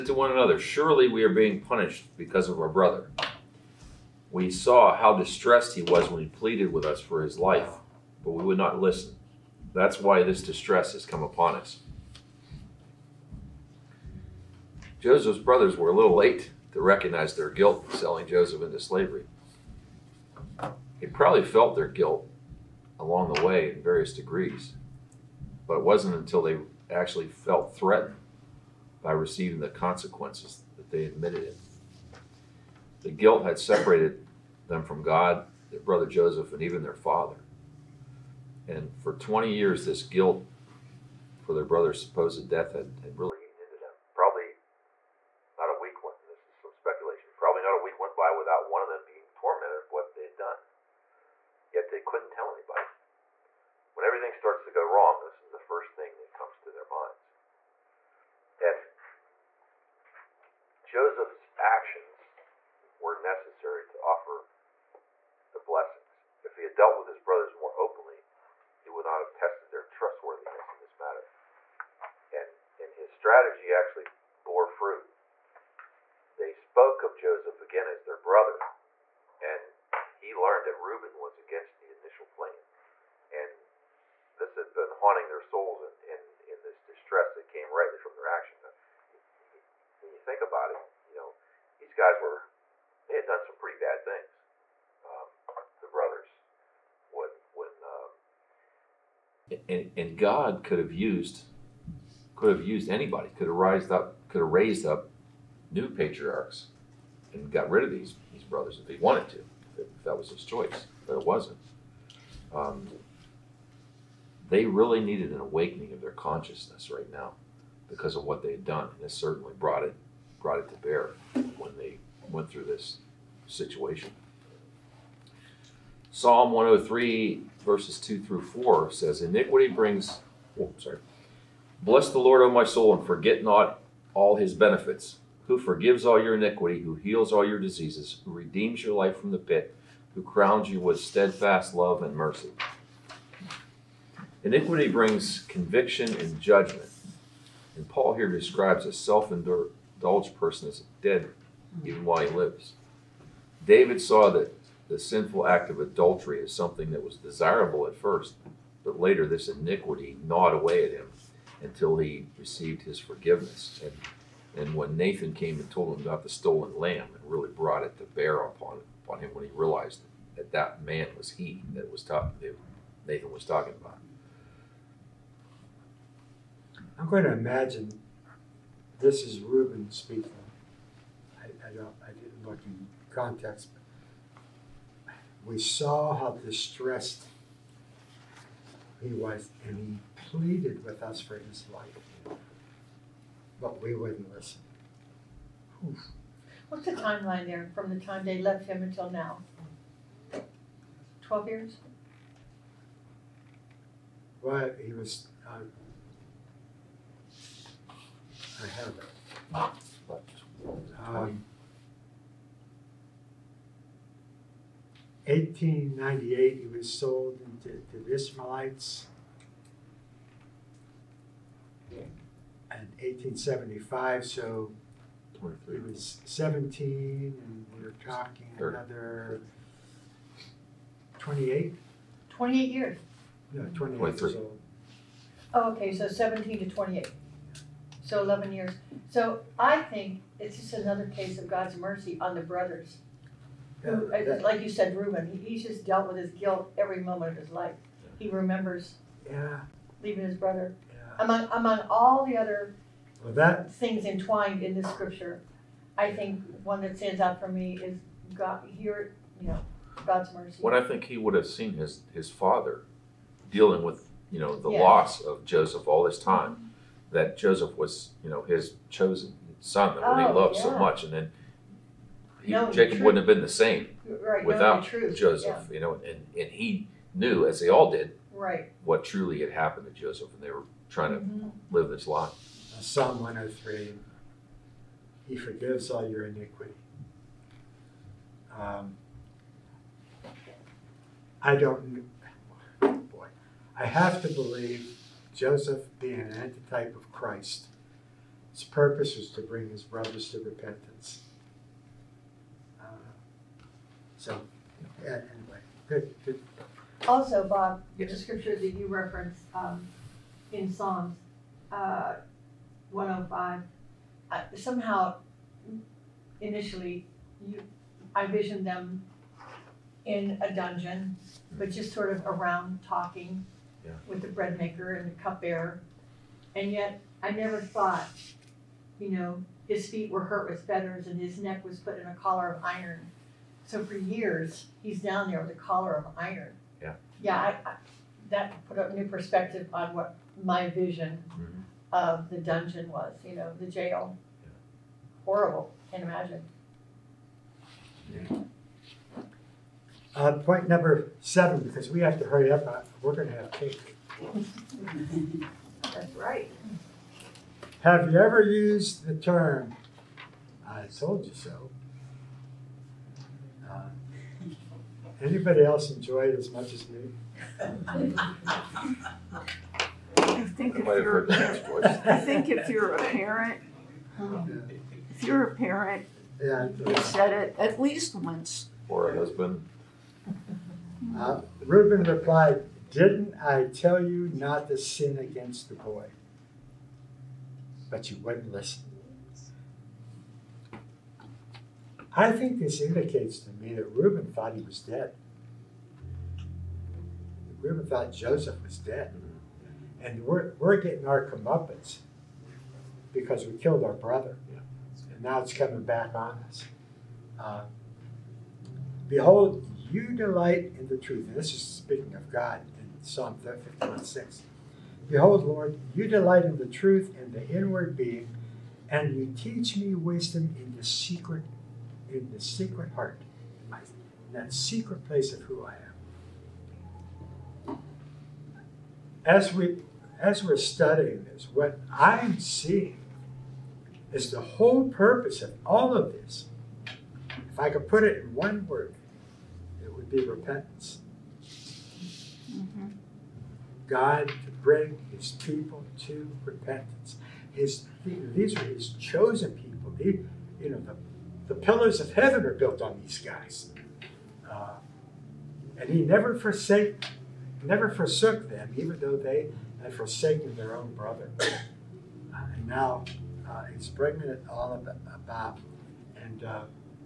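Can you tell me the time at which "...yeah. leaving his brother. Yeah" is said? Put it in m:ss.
4:09.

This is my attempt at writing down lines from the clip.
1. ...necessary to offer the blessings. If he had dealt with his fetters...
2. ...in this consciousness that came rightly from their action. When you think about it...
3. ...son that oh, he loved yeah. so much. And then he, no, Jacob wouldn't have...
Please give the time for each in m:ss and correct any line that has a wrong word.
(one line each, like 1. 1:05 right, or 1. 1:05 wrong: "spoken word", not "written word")
1. 1:03 wrong: "brothers", not "fetters"
2. 1:26 wrong: "distress", not "consciousness"
3. 4:29 right.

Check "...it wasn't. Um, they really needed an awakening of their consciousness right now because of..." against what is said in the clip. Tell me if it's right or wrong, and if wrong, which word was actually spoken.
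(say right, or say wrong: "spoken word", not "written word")
right.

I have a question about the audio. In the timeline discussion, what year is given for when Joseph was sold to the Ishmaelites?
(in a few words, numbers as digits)
1898.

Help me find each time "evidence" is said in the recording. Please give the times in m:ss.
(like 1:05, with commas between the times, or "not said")
not said.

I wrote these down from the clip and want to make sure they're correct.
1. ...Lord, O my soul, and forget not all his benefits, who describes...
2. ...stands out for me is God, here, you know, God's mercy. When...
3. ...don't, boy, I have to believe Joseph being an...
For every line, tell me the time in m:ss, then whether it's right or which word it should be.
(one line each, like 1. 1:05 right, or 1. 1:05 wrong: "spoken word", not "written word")
1. 2:12 wrong: "forgives", not "describes"
2. 4:16 right
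3. 4:51 right.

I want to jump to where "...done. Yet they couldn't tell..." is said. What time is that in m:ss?
0:50.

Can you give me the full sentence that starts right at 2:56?
I'm going to imagine this is Reuben speaking.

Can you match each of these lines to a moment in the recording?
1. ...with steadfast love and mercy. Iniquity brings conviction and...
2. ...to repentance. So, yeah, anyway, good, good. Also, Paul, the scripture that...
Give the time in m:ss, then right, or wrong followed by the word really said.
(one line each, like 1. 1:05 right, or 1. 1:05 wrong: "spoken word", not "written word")
1. 2:20 right
2. 5:00 wrong: "Bob", not "Paul".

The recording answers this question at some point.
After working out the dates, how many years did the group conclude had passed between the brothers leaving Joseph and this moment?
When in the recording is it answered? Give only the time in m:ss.
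3:58.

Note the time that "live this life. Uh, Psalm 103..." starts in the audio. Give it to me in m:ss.
4:41.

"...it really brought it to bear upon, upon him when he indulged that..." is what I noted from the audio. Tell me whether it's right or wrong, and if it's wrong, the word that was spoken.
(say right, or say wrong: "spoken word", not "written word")
wrong: "realized", not "indulged".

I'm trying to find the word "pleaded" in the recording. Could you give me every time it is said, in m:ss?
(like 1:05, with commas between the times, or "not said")
0:06, 3:10.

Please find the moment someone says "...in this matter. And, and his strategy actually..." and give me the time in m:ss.
1:10.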